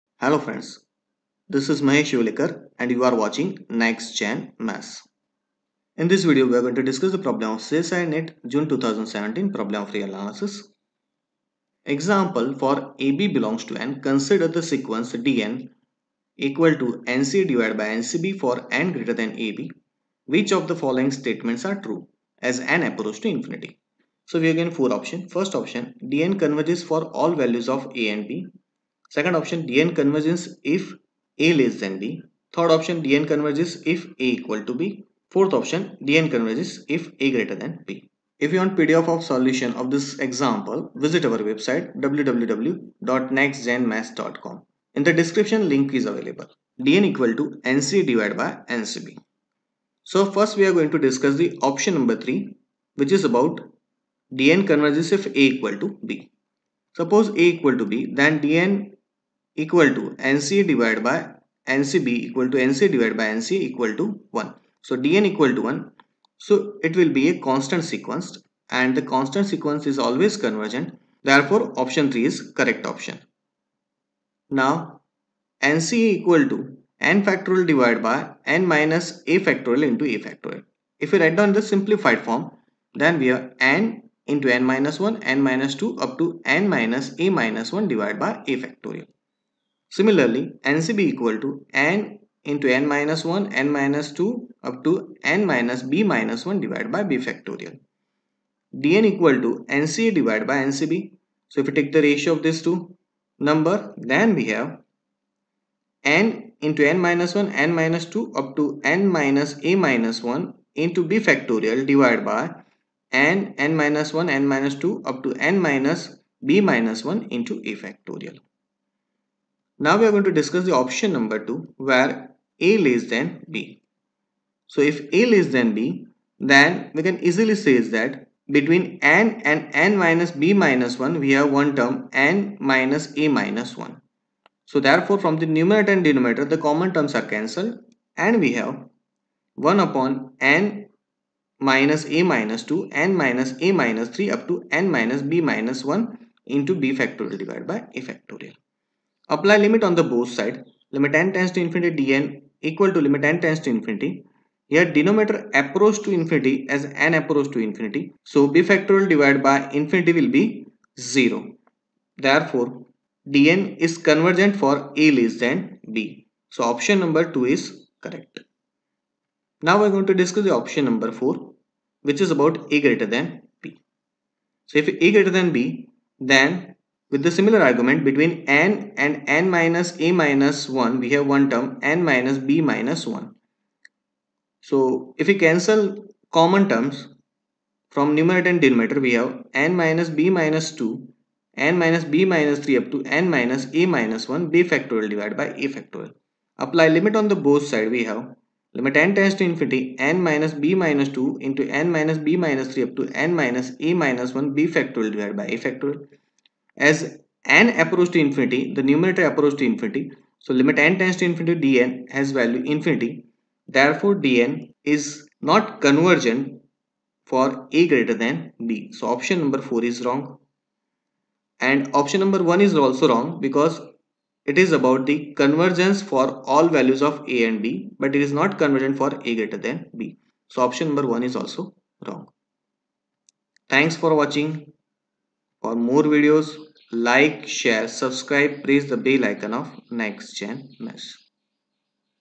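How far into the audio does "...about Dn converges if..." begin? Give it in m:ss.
0:53.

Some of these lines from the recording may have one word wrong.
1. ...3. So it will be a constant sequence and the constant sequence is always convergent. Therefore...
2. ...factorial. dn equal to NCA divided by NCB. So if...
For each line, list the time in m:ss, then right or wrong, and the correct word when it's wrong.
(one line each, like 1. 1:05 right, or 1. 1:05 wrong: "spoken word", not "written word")
1. 1:05 wrong: "1", not "3"
2. 1:37 right.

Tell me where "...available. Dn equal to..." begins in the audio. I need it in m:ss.
0:46.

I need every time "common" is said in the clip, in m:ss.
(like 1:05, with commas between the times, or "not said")
2:16, 3:06.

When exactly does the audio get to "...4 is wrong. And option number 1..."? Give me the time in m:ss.
3:39.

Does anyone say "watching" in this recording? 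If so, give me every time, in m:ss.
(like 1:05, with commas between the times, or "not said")
0:03, 3:54.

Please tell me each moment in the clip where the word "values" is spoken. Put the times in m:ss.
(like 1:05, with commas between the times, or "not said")
0:27, 3:32, 3:46.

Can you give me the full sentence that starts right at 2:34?
Here denominator approach to infinity as n approach to infinity.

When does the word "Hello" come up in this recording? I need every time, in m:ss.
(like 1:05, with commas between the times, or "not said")
0:00.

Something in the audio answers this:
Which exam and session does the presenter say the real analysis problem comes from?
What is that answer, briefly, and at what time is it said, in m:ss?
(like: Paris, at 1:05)
CSIR NET June 2017, at 0:07.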